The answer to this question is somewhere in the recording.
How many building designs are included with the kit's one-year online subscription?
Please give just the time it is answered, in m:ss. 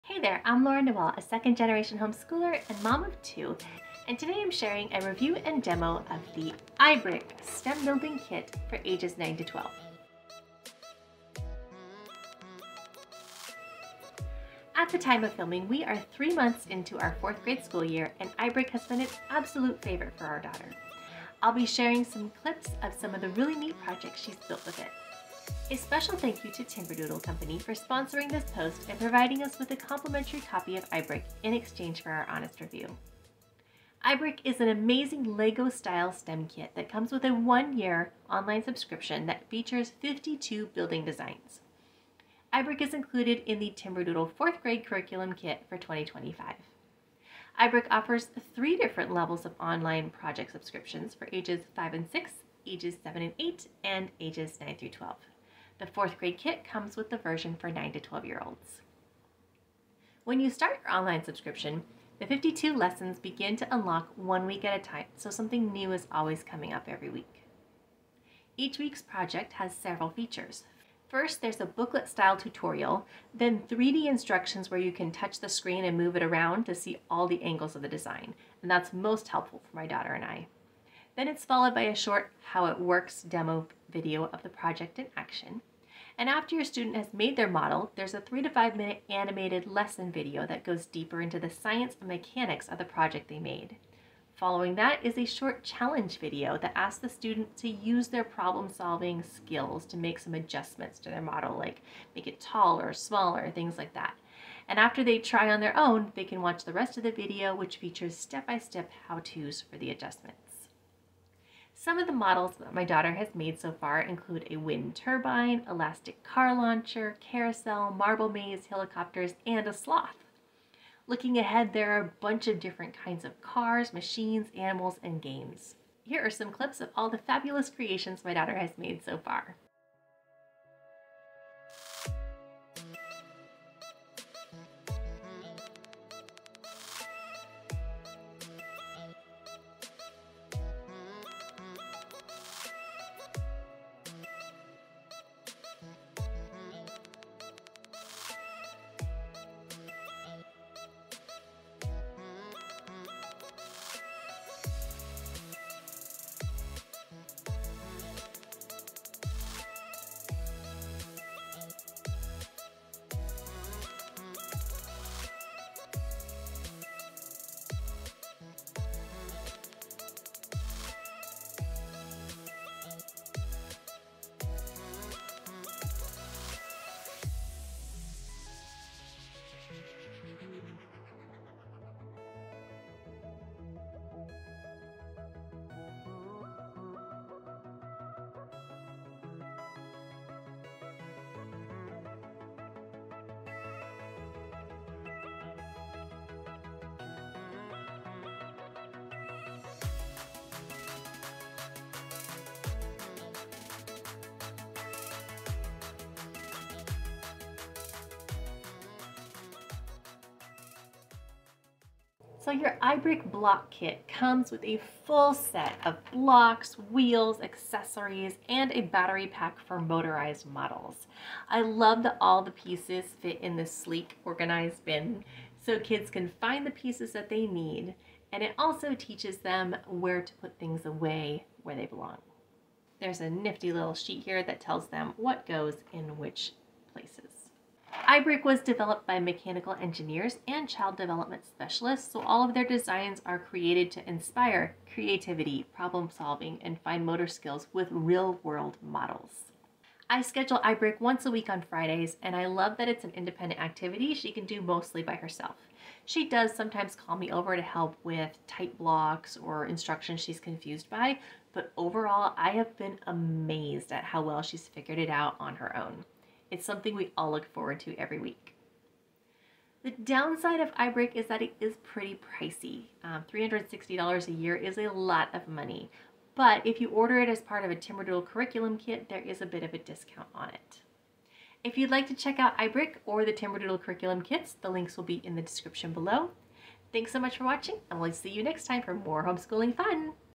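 0:40.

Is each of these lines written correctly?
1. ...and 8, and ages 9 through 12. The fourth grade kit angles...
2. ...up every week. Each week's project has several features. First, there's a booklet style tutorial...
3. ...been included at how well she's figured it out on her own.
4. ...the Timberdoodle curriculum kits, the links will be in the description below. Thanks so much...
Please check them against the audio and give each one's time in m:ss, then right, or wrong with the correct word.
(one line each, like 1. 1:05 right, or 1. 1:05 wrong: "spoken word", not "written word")
1. 0:53 wrong: "comes", not "angles"
2. 1:06 right
3. 4:22 wrong: "amazed", not "included"
4. 4:43 right.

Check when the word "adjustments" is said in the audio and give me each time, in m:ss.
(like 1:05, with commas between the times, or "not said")
1:40, 1:49.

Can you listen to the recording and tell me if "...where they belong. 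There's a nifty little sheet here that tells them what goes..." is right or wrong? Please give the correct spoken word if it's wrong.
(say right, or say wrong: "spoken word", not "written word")
right.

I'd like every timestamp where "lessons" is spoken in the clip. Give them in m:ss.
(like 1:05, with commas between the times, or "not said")
1:02, 1:29.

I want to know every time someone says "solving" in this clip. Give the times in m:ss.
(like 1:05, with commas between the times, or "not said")
1:38, 4:06.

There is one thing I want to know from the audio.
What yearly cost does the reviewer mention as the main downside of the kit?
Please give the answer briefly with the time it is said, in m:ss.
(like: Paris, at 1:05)
$360, at 4:33.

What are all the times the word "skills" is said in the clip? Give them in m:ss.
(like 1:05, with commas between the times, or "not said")
1:39, 4:07.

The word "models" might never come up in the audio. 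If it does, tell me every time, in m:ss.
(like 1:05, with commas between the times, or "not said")
1:27, 1:41, 1:52, 3:40, 4:08.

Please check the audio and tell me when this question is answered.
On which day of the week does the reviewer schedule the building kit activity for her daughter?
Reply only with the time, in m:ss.
4:11.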